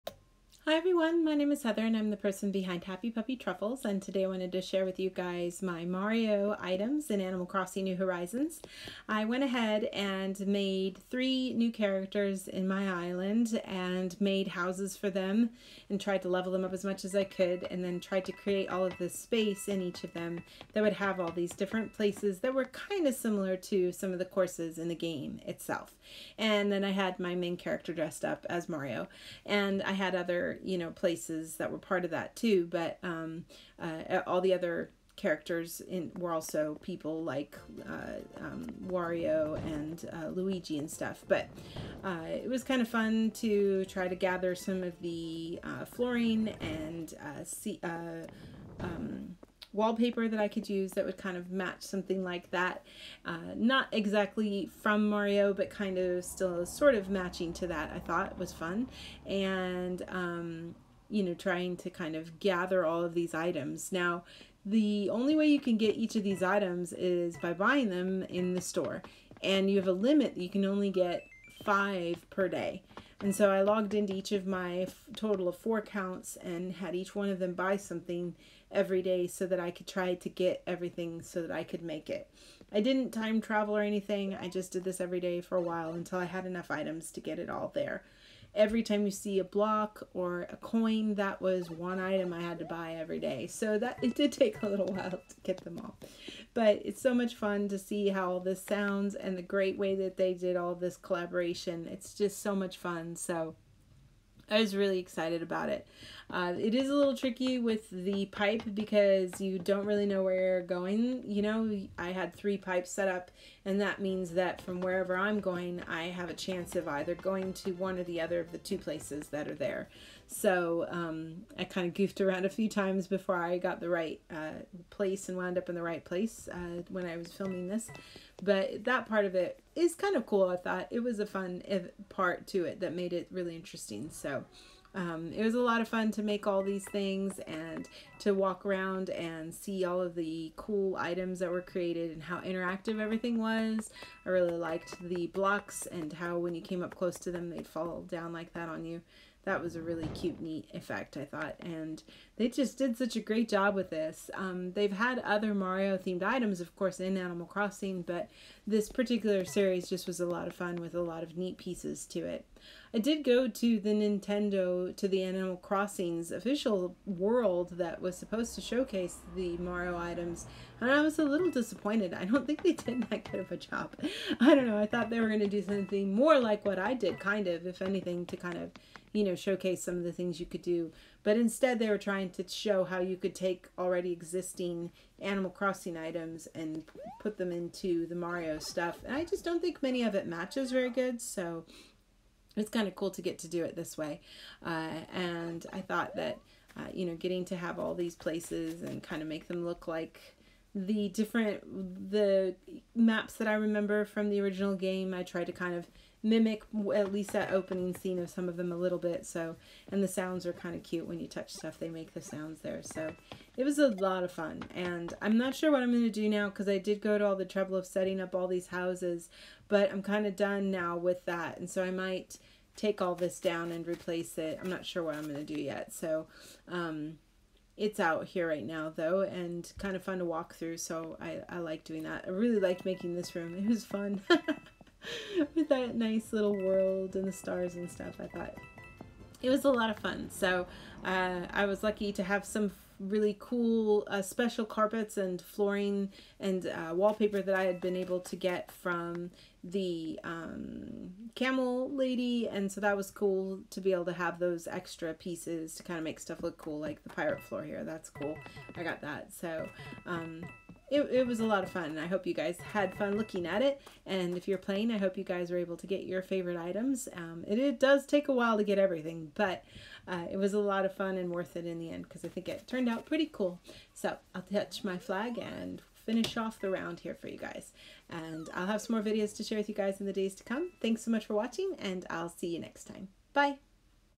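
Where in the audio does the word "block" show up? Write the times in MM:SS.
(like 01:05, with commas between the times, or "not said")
01:29, 02:25.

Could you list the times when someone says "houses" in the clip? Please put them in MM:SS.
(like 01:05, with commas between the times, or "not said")
00:14, 03:38.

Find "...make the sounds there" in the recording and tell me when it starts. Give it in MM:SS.
03:31.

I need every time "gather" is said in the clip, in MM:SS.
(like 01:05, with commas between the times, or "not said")
00:44, 01:02.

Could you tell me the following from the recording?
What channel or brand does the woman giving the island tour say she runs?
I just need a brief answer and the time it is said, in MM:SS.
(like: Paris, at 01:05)
Happy Puppy Truffles, at 00:02.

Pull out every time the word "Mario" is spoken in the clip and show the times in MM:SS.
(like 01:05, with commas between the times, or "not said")
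00:05, 00:28, 00:55, 02:35, 02:49, 03:08.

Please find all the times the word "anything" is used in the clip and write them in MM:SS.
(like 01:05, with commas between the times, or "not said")
01:23, 02:57.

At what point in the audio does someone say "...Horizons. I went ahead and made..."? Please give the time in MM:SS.
00:07.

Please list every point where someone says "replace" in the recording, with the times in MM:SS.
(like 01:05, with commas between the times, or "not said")
03:43.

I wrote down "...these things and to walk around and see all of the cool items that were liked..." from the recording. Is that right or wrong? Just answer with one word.
wrong.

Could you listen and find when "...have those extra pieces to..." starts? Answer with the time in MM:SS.
04:14.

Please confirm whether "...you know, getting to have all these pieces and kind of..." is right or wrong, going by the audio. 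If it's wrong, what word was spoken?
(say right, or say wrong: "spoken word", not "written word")
wrong: "places", not "pieces".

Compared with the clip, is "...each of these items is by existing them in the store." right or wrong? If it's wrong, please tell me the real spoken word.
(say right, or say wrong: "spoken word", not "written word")
wrong: "buying", not "existing".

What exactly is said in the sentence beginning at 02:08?
But that part of it is kind of cool, I thought.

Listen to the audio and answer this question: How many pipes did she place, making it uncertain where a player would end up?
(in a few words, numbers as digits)
3.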